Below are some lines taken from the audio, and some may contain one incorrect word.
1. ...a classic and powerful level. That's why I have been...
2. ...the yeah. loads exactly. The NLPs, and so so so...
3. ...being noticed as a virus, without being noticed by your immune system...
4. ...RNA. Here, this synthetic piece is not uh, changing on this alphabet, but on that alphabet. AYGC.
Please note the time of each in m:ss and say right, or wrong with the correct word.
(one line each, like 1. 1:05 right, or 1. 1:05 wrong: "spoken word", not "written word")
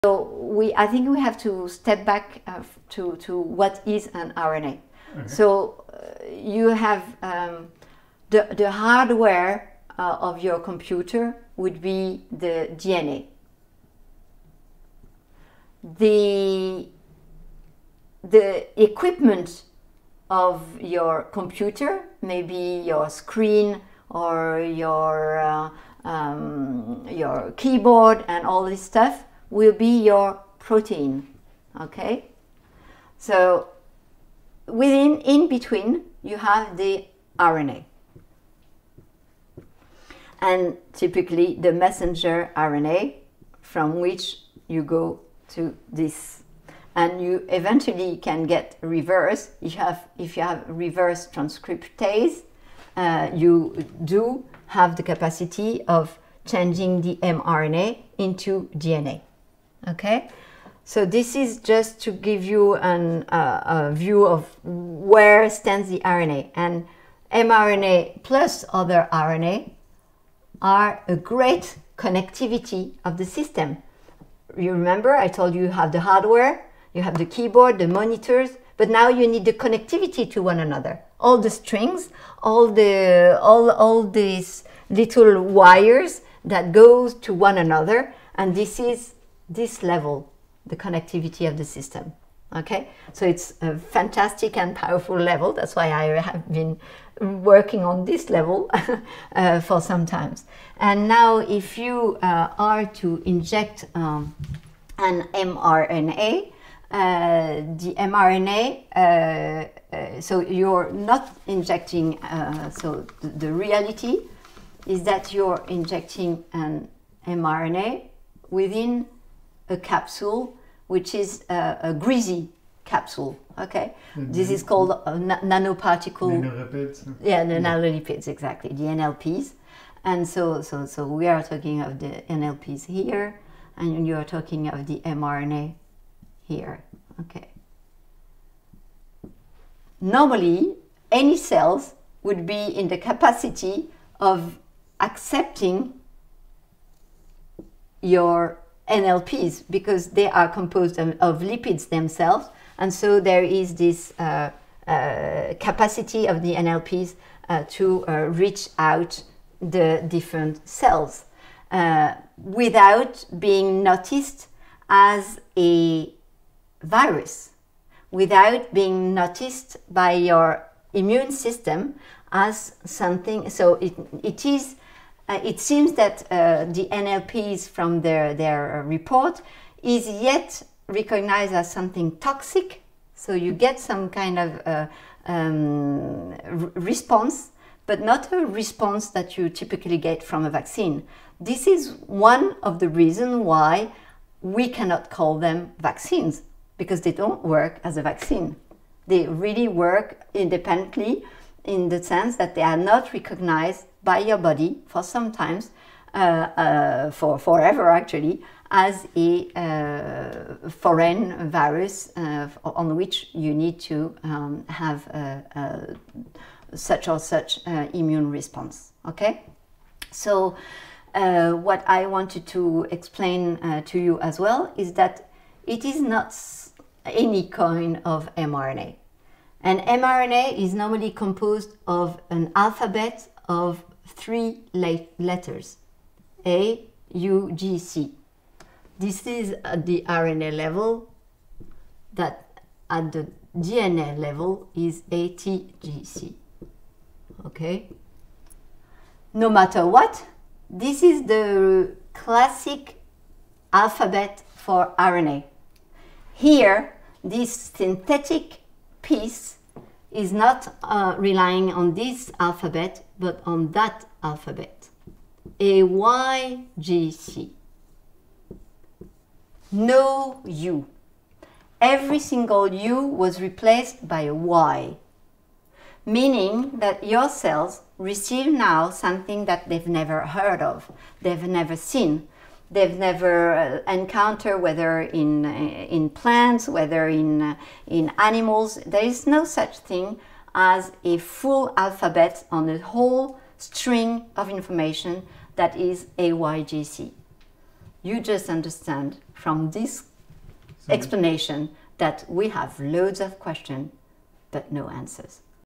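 1. 1:33 wrong: "fantastic", not "classic"
2. 2:07 wrong: "nanolipids", not "loads"
3. 2:43 right
4. 4:14 wrong: "relying", not "changing".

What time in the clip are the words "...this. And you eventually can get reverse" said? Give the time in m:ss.
0:45.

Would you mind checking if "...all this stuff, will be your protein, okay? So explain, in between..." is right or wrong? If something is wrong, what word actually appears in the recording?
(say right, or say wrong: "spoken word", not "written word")
wrong: "within", not "explain".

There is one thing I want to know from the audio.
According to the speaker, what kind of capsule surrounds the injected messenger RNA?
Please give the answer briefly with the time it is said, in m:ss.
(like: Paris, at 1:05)
A greasy capsule, at 2:01.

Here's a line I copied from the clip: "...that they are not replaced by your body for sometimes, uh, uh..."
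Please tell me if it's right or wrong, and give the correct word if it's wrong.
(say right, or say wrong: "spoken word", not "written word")
wrong: "recognized", not "replaced".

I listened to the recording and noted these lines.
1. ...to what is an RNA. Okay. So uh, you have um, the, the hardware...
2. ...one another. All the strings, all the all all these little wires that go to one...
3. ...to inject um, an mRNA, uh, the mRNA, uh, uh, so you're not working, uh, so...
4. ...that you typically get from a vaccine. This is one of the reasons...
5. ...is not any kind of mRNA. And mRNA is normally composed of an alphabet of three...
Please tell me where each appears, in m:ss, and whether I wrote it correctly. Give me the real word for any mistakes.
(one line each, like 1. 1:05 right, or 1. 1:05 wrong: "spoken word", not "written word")
1. 0:03 right
2. 1:20 right
3. 1:42 wrong: "injecting", not "working"
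4. 3:09 right
5. 3:45 right.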